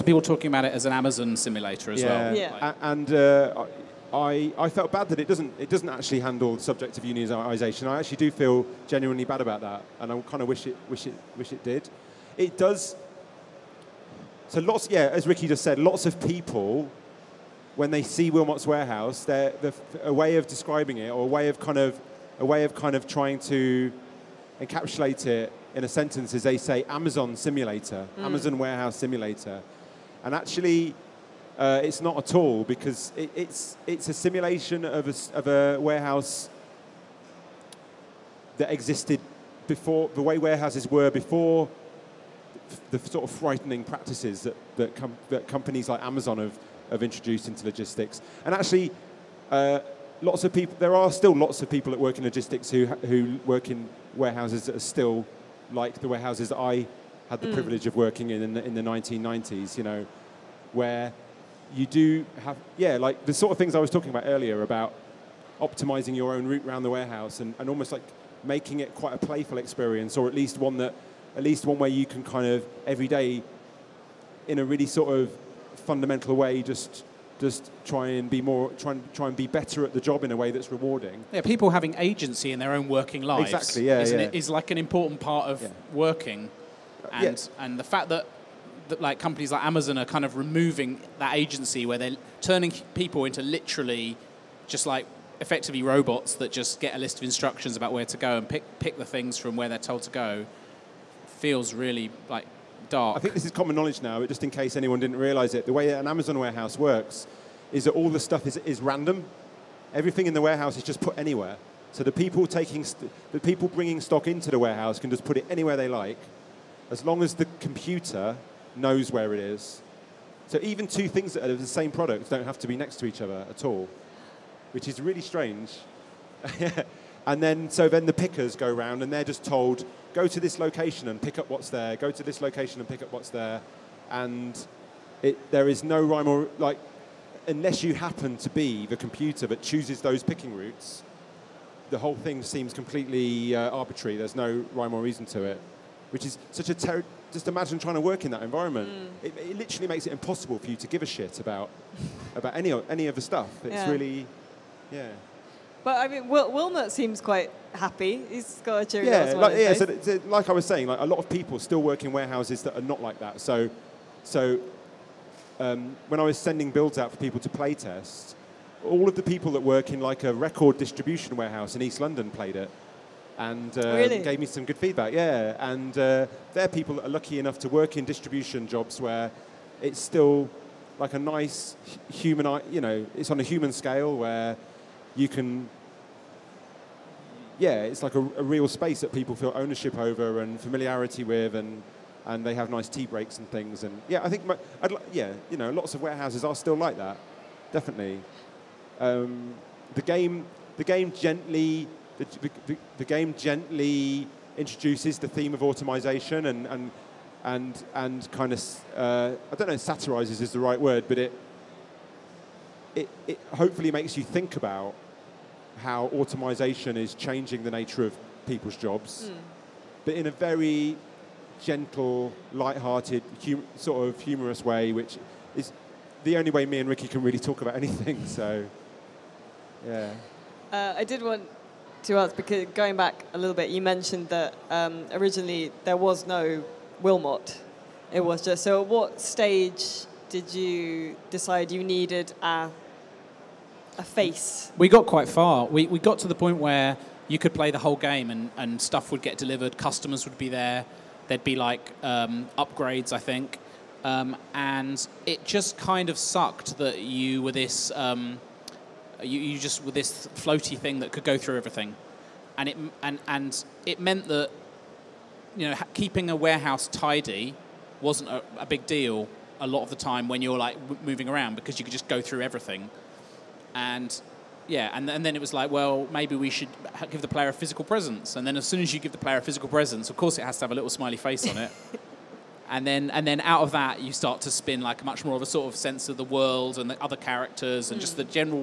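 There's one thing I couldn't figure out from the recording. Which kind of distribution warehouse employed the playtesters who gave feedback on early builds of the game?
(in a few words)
Record distribution warehouse.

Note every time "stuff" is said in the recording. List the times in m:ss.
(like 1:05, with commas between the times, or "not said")
1:48, 2:33, 4:08.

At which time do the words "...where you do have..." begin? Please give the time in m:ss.
1:00.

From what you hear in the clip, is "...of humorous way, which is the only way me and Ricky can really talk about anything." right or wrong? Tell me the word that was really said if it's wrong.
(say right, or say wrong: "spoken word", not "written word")
right.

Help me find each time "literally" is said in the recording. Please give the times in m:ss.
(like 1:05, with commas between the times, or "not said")
1:33, 2:29.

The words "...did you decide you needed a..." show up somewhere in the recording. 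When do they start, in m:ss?
4:00.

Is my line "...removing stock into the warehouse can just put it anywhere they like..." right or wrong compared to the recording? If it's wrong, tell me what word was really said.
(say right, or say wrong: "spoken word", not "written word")
wrong: "bringing", not "removing".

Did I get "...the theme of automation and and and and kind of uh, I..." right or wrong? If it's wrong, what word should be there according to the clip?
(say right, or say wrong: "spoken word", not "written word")
right.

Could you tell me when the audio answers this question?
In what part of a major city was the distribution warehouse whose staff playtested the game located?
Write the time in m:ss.
2:51.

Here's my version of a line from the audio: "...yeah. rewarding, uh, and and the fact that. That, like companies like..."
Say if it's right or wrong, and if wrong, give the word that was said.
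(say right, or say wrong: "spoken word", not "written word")
wrong: "working", not "rewarding".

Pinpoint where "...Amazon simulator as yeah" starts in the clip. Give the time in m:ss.
0:00.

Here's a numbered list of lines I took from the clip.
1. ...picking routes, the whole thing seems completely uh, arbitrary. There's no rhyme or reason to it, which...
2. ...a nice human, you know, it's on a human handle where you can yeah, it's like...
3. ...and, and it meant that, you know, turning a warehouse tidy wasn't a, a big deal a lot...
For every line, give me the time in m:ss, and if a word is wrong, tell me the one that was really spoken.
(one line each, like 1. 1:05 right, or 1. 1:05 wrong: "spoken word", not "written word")
1. 2:20 right
2. 3:01 wrong: "scale", not "handle"
3. 4:23 wrong: "keeping", not "turning".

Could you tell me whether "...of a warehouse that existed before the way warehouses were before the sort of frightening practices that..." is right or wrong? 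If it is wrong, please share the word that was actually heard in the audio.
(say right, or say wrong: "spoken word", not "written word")
right.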